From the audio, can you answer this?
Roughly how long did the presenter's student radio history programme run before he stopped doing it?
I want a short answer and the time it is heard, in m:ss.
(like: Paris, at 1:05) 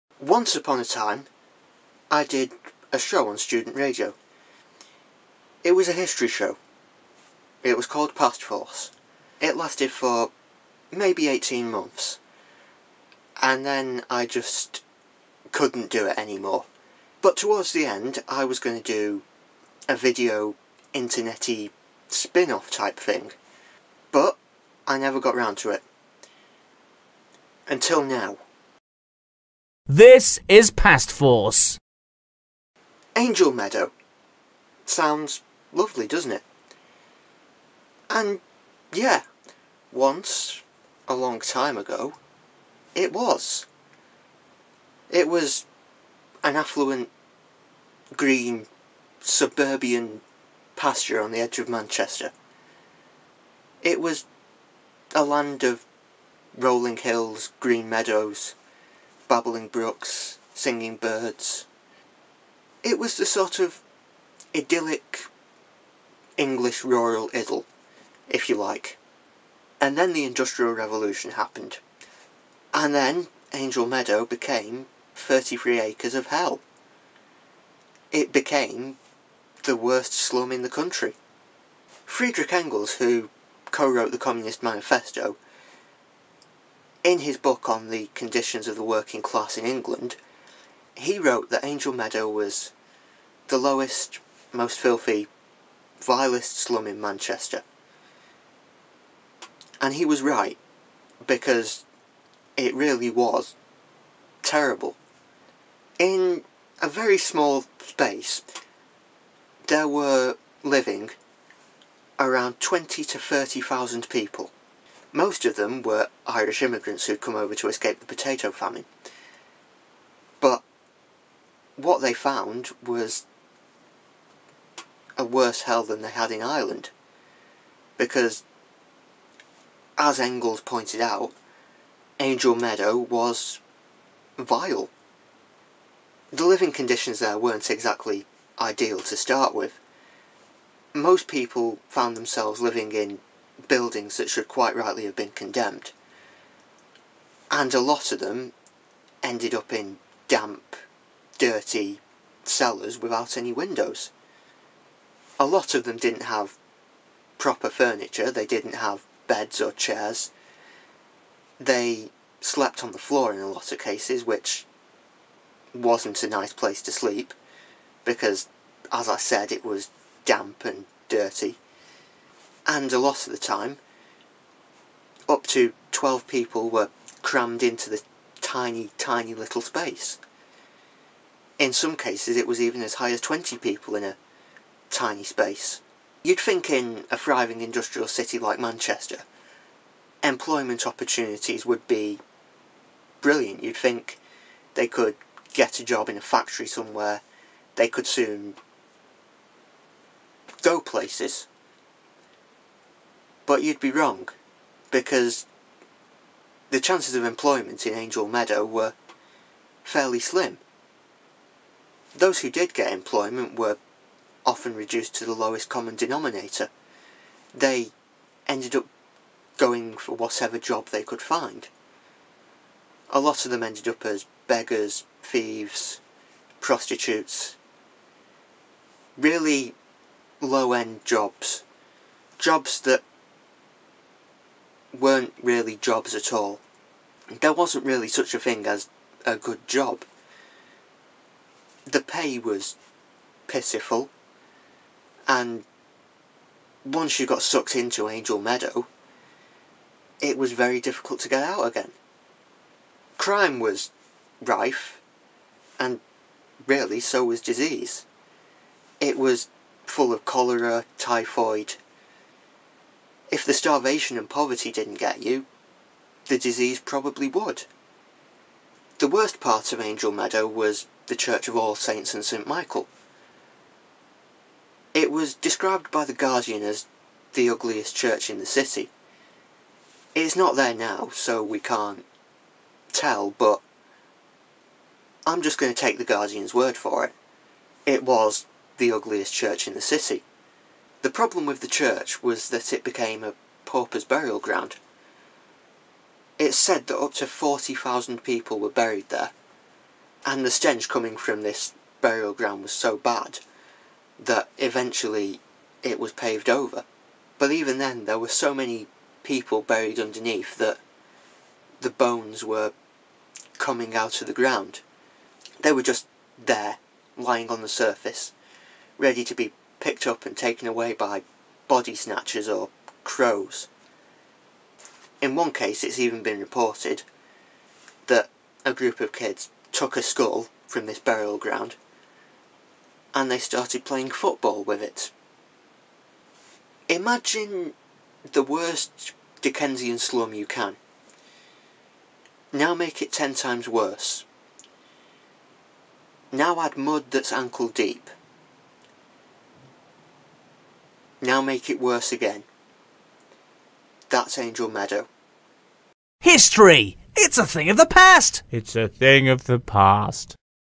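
18 months, at 0:11.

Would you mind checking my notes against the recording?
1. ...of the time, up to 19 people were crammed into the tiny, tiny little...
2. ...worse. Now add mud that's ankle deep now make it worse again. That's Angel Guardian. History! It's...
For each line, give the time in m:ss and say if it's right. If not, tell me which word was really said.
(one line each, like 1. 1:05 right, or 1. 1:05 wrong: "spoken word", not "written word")
1. 2:53 wrong: "12", not "19"
2. 5:43 wrong: "Meadow", not "Guardian".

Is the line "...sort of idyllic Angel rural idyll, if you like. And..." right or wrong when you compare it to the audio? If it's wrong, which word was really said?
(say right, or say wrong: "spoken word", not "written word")
wrong: "English", not "Angel".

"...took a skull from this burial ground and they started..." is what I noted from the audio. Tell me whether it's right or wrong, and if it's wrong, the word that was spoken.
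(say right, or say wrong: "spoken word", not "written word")
right.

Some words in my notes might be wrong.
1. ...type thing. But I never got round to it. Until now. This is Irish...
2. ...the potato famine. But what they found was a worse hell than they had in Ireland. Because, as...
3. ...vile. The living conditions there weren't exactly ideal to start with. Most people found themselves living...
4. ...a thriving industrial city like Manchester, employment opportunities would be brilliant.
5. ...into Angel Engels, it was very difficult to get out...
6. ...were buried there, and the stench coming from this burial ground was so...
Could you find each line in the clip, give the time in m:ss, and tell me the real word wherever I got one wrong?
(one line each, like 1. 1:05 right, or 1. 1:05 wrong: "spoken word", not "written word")
1. 0:22 wrong: "Past", not "Irish"
2. 1:57 right
3. 2:14 right
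4. 3:07 right
5. 4:07 wrong: "Meadow", not "Engels"
6. 4:58 right.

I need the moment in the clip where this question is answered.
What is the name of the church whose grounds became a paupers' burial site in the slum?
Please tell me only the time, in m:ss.
4:31.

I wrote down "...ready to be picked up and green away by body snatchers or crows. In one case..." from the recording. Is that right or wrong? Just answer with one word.
wrong.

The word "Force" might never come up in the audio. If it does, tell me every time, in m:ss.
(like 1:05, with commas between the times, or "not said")
0:08, 0:31.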